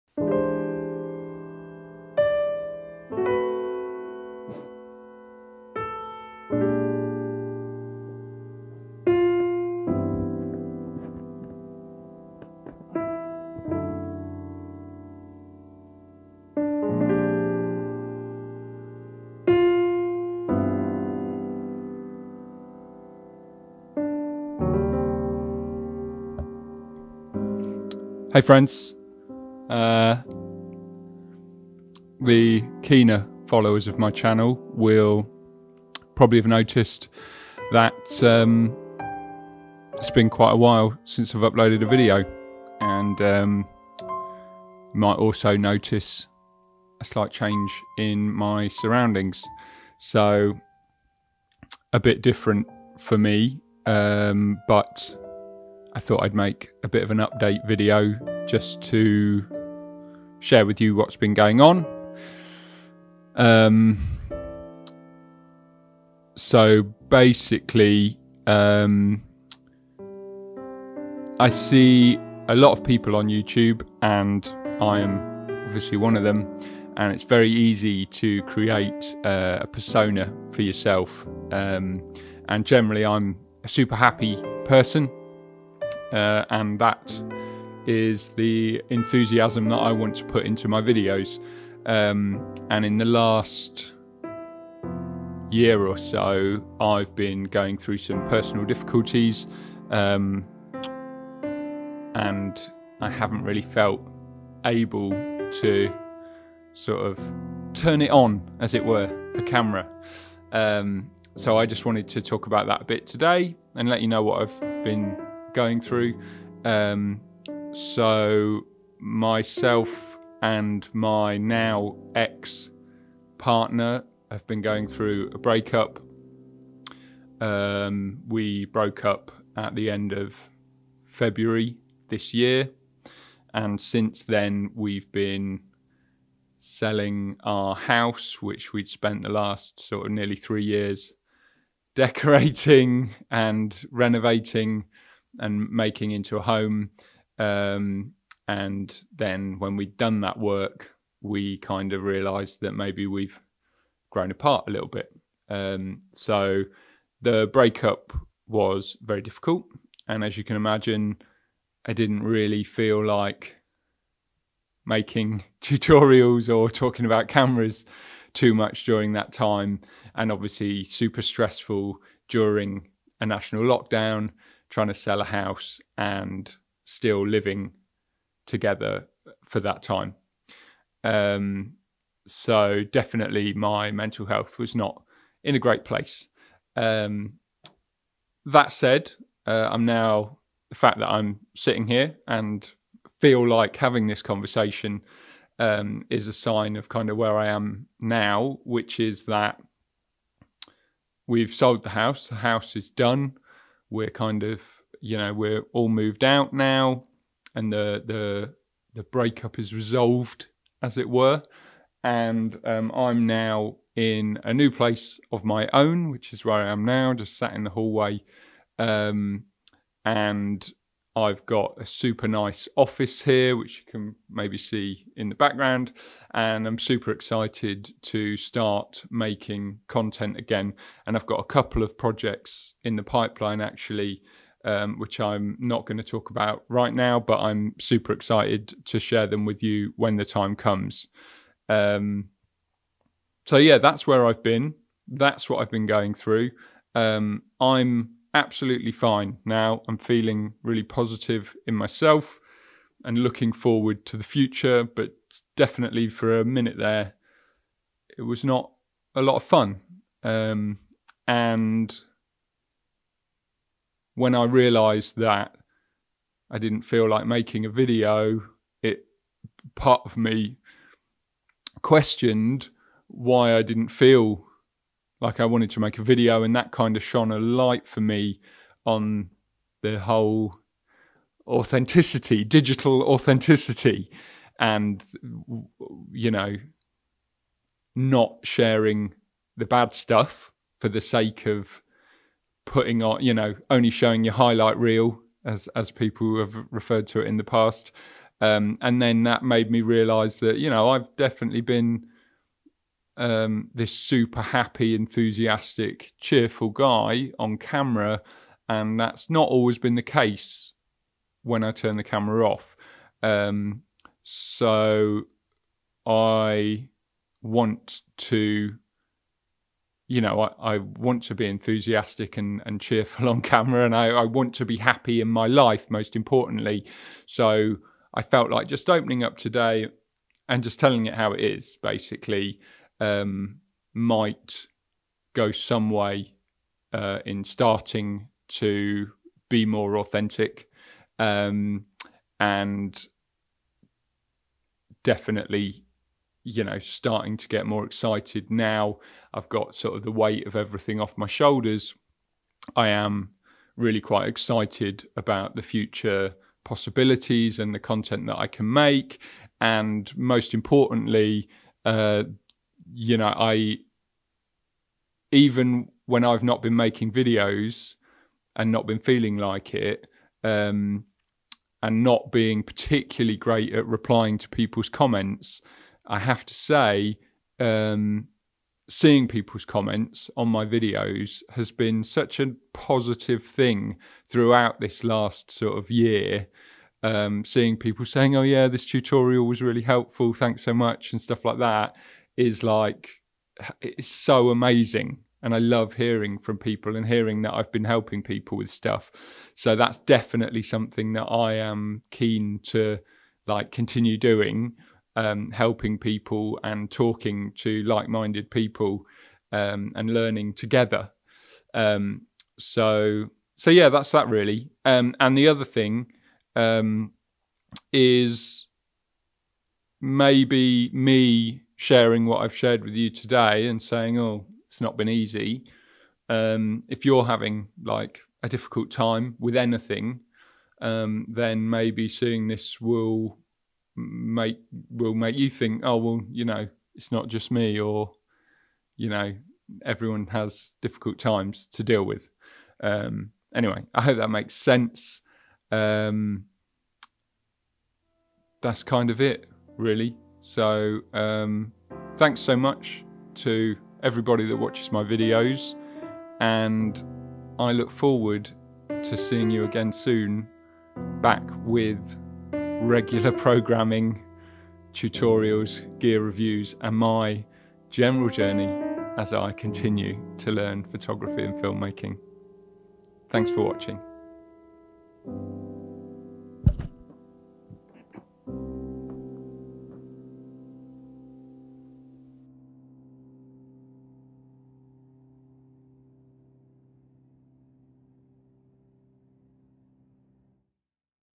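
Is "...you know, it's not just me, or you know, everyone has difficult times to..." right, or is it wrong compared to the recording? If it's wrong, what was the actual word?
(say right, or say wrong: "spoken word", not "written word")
right.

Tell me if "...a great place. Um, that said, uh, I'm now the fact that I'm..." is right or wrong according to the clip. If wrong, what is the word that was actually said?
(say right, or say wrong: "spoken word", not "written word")
right.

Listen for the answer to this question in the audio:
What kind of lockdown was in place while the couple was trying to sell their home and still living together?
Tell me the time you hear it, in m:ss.
2:53.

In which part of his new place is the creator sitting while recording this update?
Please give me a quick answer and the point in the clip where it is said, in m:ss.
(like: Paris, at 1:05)
the hallway, at 3:37.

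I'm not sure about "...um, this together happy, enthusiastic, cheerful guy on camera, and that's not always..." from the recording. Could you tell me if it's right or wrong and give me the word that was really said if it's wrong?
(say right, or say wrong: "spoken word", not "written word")
wrong: "super", not "together".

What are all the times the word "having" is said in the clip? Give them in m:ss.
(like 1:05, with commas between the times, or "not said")
3:13, 7:07.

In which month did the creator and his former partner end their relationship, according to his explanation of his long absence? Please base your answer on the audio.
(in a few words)
February.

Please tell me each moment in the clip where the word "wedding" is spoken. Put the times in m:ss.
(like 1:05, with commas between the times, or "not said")
not said.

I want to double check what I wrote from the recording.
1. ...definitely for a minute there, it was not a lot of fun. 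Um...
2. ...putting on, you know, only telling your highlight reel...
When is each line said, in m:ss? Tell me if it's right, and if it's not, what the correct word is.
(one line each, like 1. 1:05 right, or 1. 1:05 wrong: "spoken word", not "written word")
1. 4:15 right
2. 4:52 wrong: "showing", not "telling".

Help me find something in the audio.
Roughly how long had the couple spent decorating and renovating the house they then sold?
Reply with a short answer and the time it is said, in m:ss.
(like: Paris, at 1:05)
nearly 3 years, at 2:20.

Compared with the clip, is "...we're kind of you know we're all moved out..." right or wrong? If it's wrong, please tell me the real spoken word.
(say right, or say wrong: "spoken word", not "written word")
right.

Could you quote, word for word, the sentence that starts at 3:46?
And I'm super excited to start making content again.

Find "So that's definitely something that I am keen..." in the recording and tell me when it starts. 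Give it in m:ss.
6:39.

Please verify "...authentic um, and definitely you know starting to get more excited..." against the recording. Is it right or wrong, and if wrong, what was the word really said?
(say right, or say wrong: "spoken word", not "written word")
right.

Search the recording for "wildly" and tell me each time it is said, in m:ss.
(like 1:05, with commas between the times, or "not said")
not said.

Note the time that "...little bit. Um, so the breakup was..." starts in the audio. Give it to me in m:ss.
2:34.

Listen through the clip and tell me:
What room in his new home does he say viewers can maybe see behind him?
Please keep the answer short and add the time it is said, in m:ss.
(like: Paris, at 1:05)
office, at 3:42.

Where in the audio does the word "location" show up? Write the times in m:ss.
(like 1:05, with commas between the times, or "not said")
not said.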